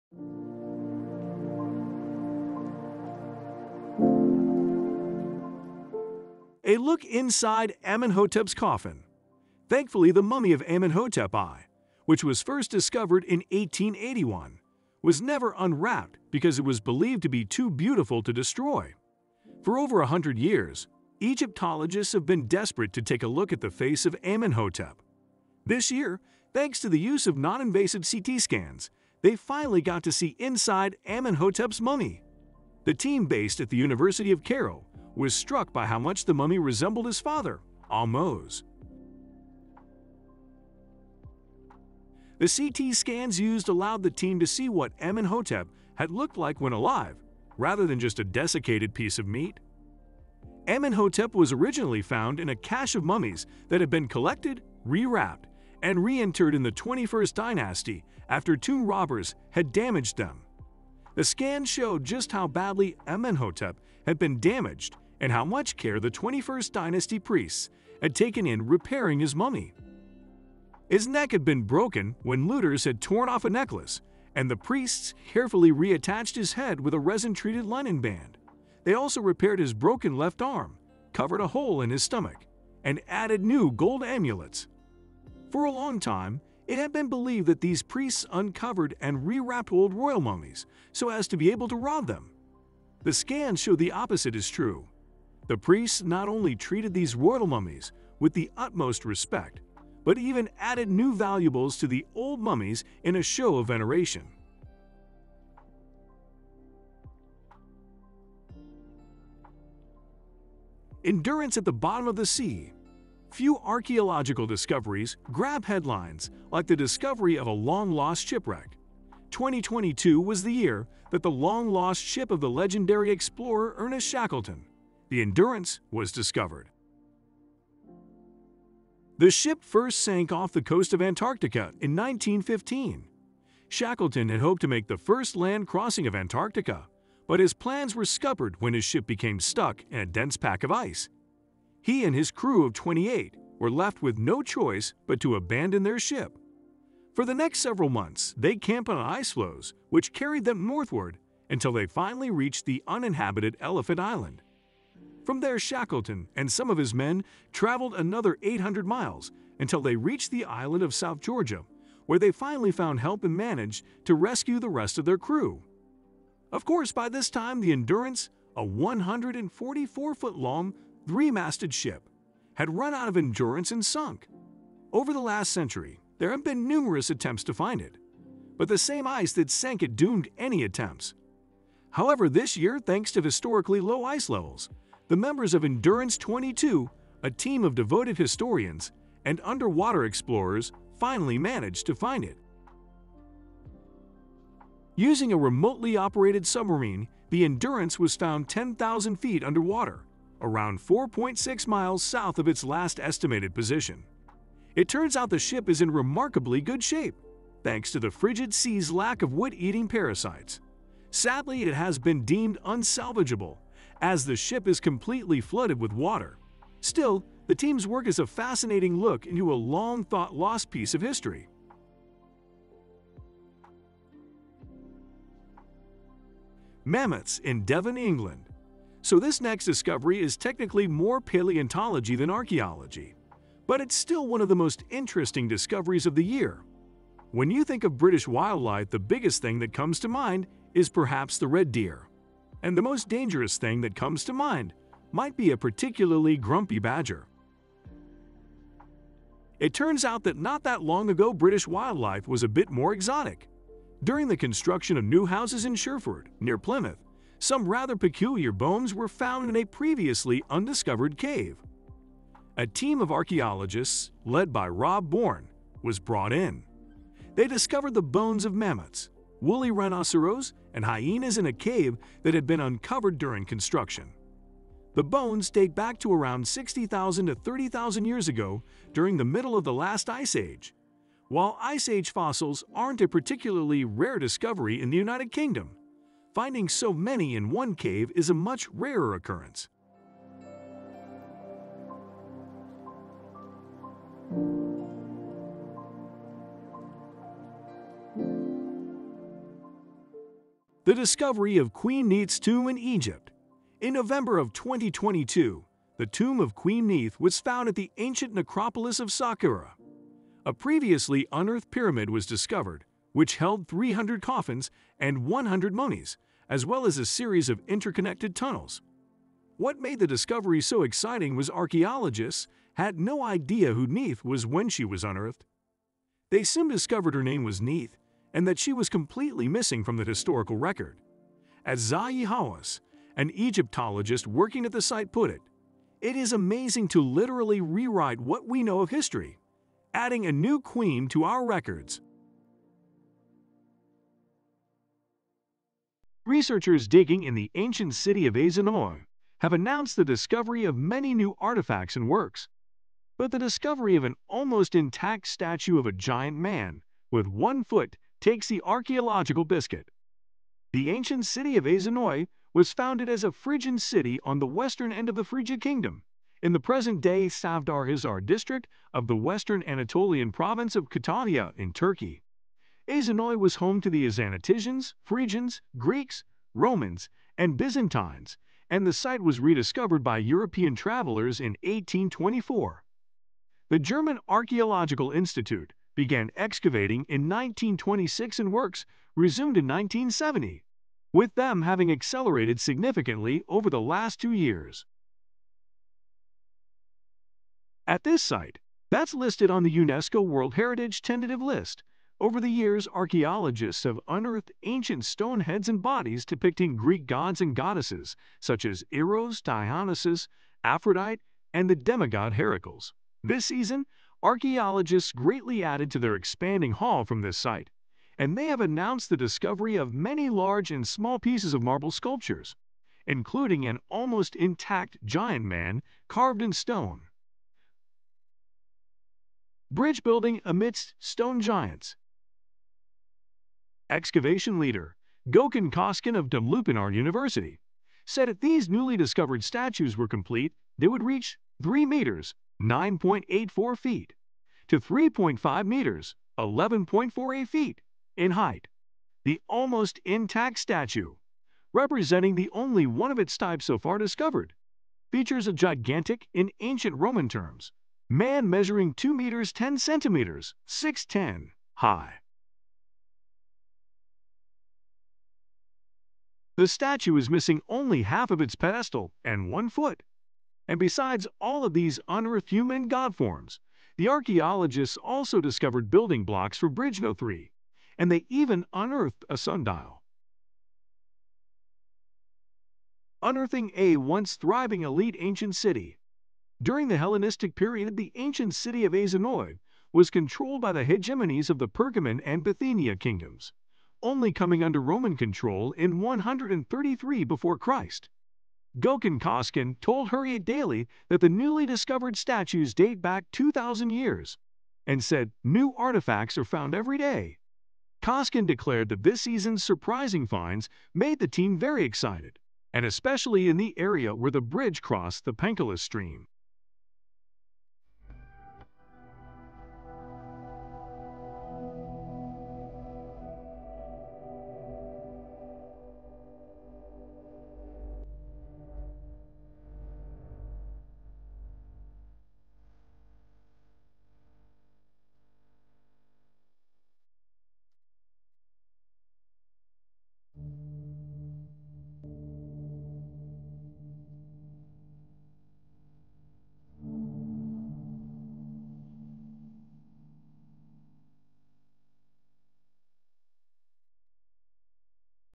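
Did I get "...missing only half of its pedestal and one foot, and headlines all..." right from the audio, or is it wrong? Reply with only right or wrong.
wrong.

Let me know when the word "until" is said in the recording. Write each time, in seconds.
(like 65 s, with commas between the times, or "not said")
151 s, 159 s.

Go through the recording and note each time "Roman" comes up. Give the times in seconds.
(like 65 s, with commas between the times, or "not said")
376 s, 456 s, 494 s.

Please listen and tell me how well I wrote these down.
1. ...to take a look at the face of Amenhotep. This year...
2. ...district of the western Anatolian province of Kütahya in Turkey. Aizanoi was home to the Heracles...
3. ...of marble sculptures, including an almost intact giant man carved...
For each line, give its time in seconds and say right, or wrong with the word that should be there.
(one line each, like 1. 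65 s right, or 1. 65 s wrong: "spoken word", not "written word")
1. 22 s right
2. 368 s wrong: "Azanaticians", not "Heracles"
3. 421 s right.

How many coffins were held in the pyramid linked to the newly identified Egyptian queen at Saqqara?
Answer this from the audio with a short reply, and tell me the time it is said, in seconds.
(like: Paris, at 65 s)
300, at 313 s.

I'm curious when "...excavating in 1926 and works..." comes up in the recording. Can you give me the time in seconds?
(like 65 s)
386 s.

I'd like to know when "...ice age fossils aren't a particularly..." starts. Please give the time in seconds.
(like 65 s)
281 s.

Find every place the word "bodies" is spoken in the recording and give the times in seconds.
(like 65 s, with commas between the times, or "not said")
405 s.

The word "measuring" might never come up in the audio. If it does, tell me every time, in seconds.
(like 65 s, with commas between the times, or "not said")
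458 s.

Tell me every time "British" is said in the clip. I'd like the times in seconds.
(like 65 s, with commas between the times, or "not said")
237 s, 251 s.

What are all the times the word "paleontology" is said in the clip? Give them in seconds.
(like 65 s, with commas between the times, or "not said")
231 s.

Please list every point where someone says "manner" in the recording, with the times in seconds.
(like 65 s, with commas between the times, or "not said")
not said.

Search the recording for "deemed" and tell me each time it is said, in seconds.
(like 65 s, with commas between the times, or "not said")
212 s.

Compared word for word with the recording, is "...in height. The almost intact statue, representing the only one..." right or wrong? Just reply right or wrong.
right.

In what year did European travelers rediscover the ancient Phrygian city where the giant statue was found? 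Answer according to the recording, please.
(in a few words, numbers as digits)
1824.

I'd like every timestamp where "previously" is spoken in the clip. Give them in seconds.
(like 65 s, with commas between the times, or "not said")
259 s, 310 s.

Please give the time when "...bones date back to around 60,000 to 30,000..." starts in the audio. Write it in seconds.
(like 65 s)
275 s.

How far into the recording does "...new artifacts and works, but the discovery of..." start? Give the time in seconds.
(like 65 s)
351 s.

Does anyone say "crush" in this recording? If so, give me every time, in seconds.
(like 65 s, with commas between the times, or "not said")
not said.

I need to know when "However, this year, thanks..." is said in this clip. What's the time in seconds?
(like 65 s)
181 s.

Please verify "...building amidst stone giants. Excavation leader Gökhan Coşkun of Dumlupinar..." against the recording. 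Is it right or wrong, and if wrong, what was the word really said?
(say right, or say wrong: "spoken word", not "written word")
right.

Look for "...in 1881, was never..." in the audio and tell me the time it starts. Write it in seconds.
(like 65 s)
13 s.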